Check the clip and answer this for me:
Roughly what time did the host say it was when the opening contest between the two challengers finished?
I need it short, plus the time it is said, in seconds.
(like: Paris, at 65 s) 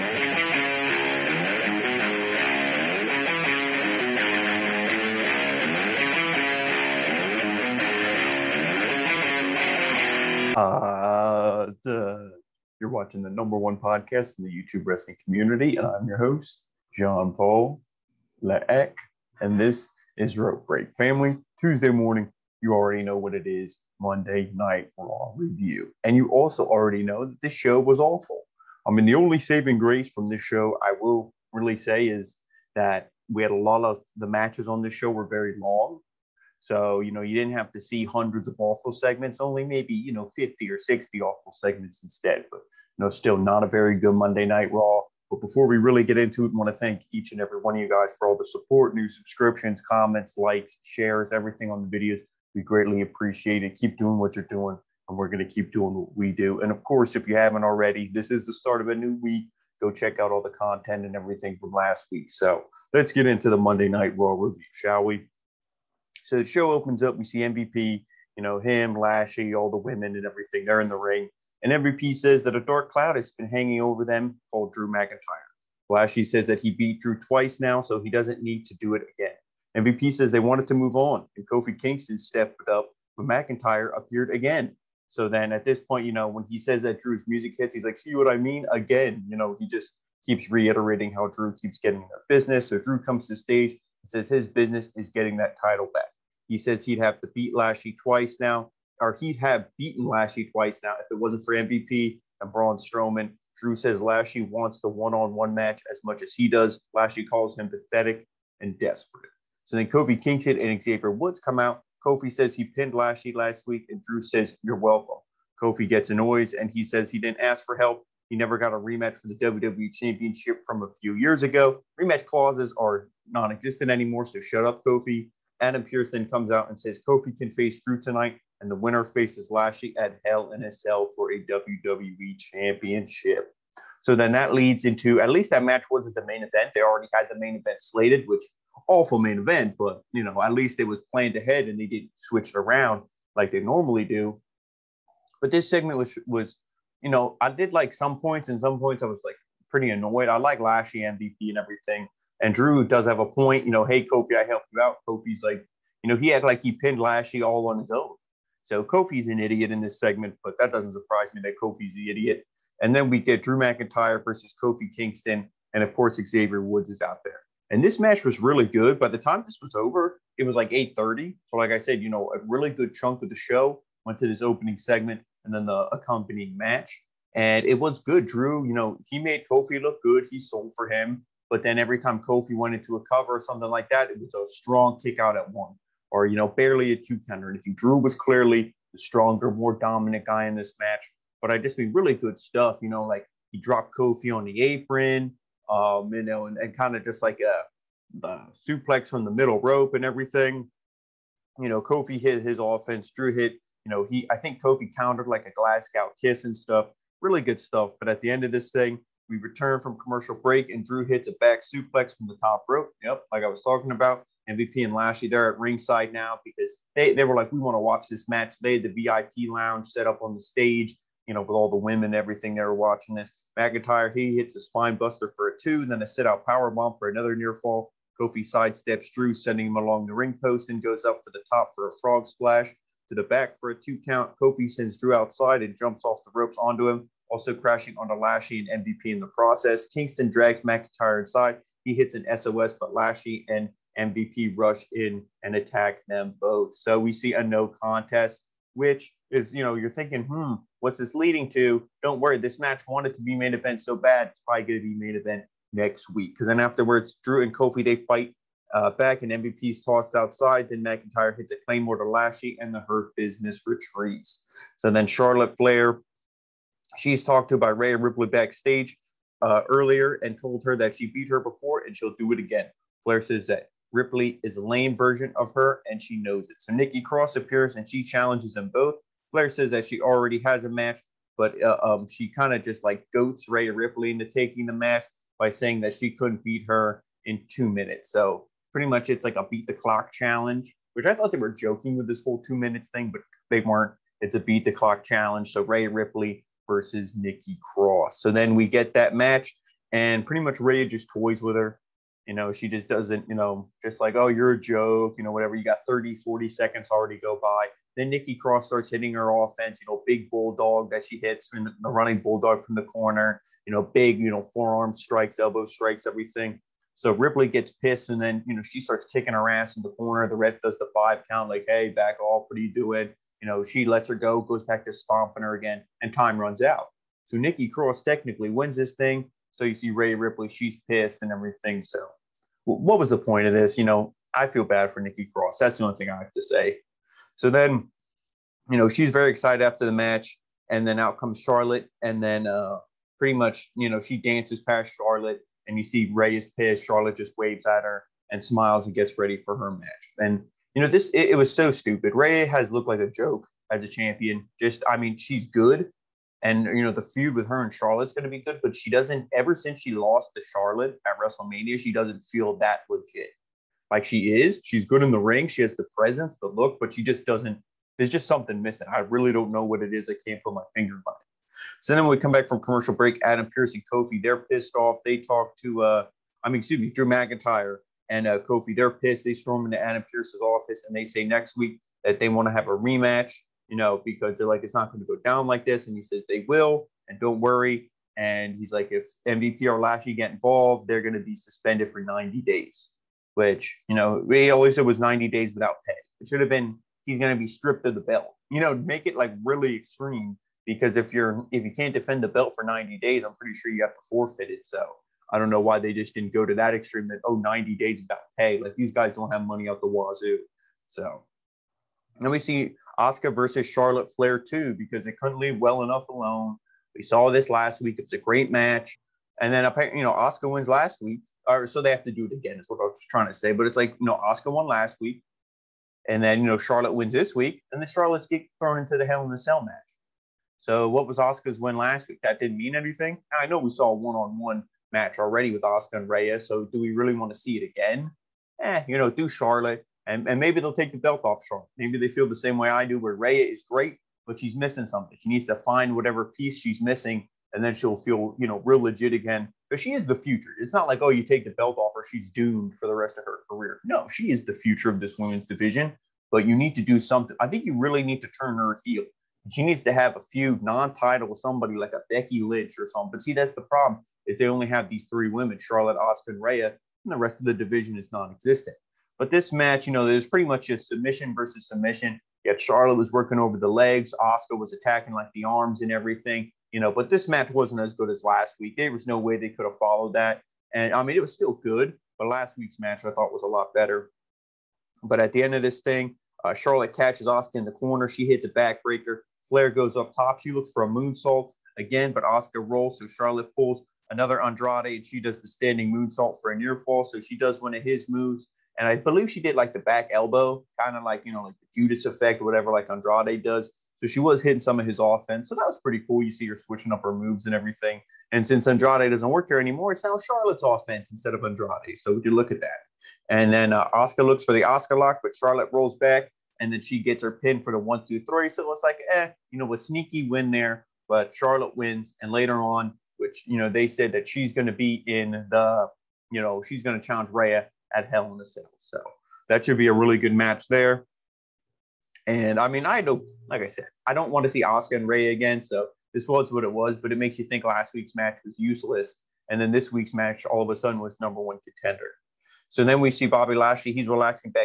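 8:30, at 170 s.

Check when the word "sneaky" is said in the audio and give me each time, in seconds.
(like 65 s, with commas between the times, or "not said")
519 s.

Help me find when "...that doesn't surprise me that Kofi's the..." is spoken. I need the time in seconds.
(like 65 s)
160 s.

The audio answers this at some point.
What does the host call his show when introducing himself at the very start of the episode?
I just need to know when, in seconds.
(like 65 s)
20 s.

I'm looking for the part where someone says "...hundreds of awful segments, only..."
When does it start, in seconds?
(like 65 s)
38 s.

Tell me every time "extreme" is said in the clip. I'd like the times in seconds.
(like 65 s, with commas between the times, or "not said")
399 s, 406 s.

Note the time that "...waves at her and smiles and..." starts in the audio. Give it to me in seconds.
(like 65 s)
347 s.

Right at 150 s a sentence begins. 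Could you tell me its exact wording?
I like Lashley MVP and everything.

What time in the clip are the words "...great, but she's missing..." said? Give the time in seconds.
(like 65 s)
443 s.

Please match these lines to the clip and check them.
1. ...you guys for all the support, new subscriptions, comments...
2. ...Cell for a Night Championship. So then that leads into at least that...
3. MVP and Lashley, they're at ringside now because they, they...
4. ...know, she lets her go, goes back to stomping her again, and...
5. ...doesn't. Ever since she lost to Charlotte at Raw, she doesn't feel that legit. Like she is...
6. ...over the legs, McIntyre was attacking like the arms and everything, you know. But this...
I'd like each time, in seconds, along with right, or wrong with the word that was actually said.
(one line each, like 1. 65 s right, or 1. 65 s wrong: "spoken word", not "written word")
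1. 47 s right
2. 130 s wrong: "WWE", not "Night"
3. 214 s right
4. 323 s right
5. 358 s wrong: "WrestleMania", not "Raw"
6. 473 s wrong: "Asuka", not "McIntyre".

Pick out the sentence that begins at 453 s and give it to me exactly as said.
No, she is the future of this women's division, but you need to do something.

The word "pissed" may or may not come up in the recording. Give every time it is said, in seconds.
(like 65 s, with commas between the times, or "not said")
317 s, 330 s, 346 s, 374 s, 378 s.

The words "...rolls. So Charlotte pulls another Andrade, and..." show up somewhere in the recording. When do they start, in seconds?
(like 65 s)
492 s.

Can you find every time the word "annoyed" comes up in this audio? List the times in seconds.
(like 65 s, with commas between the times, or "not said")
116 s, 149 s.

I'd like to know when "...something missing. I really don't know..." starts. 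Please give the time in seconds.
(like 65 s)
368 s.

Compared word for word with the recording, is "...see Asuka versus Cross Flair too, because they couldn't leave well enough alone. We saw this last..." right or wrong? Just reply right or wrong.
wrong.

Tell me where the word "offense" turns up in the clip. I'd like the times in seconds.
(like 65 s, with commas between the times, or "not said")
202 s, 309 s, 504 s, 510 s.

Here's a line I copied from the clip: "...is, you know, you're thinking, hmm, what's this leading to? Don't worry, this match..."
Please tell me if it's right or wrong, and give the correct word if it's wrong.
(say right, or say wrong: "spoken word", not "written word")
right.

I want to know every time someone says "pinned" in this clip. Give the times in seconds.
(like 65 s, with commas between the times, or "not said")
112 s, 156 s.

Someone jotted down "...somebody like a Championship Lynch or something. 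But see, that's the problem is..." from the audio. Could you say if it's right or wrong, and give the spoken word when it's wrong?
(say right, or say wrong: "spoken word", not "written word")
wrong: "Becky", not "Championship".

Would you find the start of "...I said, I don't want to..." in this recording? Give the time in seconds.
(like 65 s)
533 s.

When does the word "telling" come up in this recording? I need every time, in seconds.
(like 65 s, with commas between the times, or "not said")
not said.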